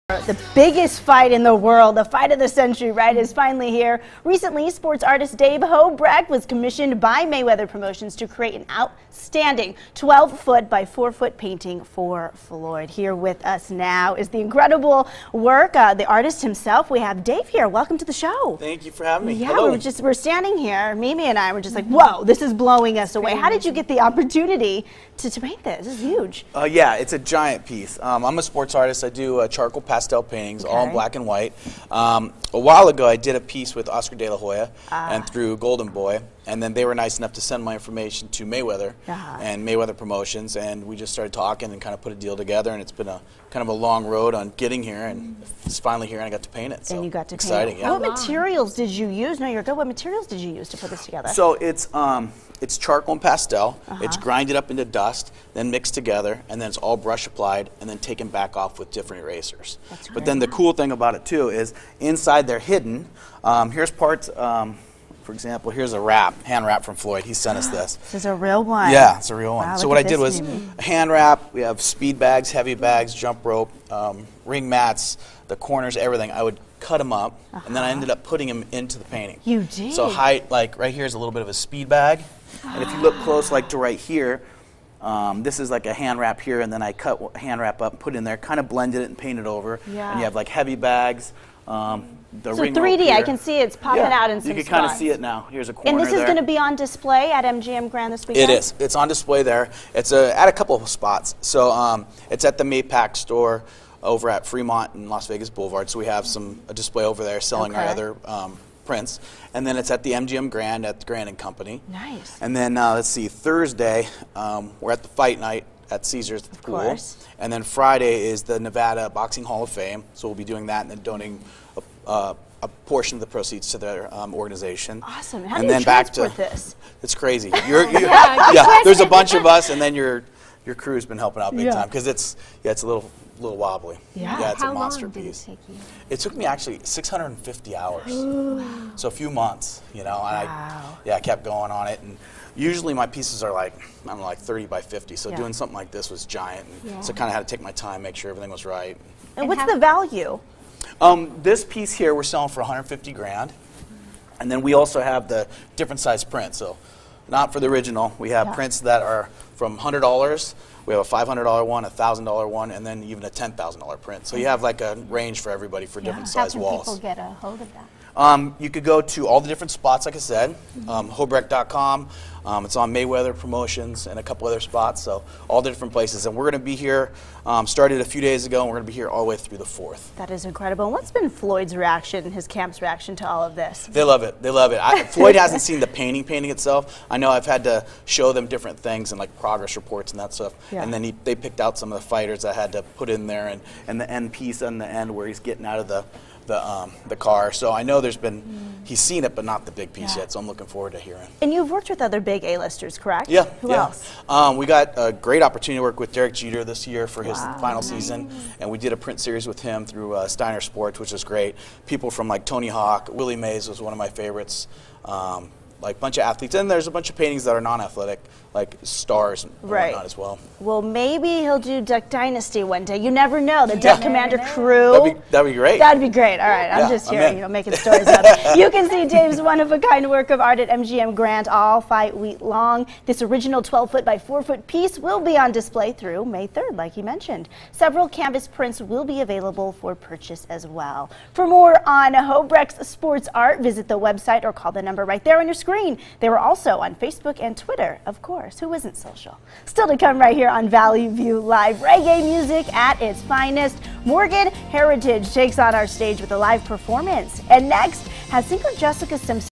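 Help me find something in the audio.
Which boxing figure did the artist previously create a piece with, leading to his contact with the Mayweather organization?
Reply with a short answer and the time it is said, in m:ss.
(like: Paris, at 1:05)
Oscar De La Hoya, at 0:33.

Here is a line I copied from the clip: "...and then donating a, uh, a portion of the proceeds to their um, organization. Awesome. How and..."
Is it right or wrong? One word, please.
right.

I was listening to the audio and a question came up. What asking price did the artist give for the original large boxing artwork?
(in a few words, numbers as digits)
$150,000.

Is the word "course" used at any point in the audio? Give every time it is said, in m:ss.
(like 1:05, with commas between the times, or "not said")
1:56, 4:08.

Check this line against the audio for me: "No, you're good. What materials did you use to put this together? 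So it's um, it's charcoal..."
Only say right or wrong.
right.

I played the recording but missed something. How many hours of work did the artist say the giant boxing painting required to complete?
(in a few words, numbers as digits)
650.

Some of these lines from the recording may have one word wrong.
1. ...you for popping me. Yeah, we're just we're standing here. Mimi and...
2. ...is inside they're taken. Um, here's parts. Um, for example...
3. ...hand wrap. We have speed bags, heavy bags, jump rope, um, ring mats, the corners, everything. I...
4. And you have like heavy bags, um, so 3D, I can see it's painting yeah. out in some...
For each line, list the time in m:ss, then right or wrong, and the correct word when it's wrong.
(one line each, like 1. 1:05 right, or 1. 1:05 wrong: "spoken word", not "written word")
1. 0:18 wrong: "having", not "popping"
2. 1:01 wrong: "hidden", not "taken"
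3. 1:10 right
4. 1:30 wrong: "popping", not "painting".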